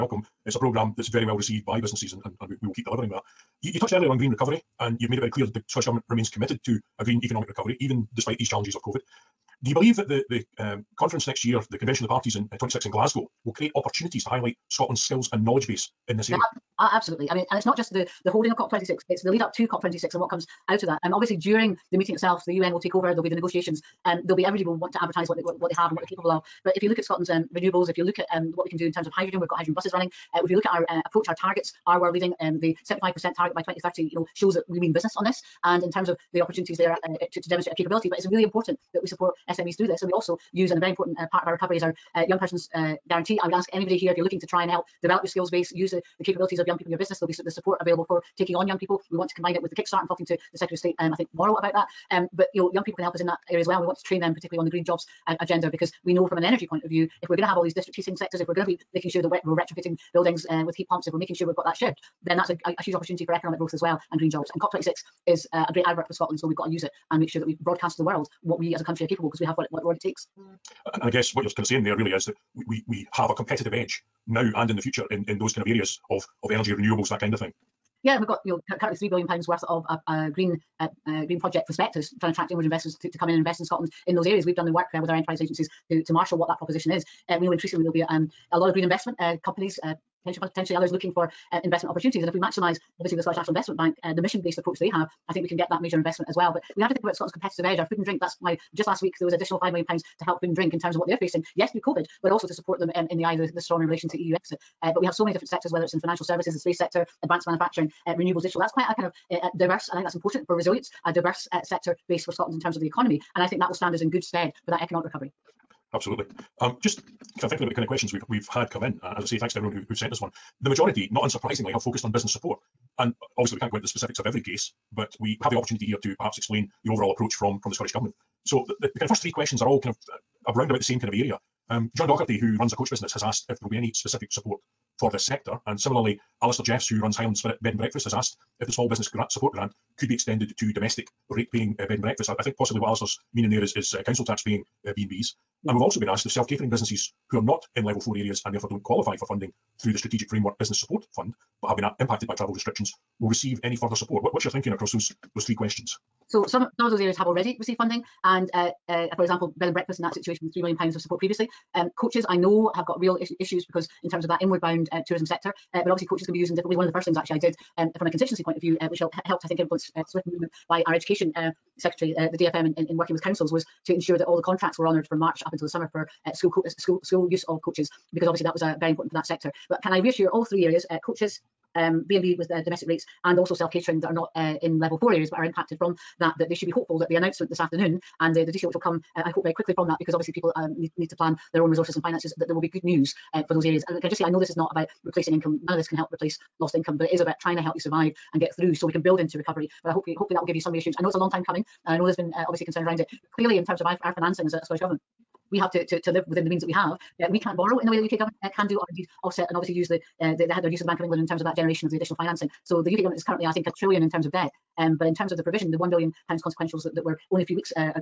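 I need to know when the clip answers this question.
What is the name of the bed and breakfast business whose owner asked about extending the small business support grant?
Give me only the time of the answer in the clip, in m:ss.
2:17.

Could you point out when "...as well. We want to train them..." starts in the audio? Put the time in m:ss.
0:53.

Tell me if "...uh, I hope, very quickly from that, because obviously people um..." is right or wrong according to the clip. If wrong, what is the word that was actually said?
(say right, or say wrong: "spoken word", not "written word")
right.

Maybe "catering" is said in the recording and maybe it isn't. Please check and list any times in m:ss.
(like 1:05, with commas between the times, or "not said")
2:26, 3:03.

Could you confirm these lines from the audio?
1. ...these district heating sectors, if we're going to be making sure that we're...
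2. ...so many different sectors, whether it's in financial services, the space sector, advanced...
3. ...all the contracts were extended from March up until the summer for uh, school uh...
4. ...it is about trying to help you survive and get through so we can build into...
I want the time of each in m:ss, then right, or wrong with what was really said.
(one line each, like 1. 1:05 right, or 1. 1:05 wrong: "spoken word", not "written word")
1. 0:57 right
2. 1:45 right
3. 2:54 wrong: "honoured", not "extended"
4. 3:17 right.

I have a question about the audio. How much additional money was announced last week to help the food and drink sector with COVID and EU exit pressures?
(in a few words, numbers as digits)
£5 million.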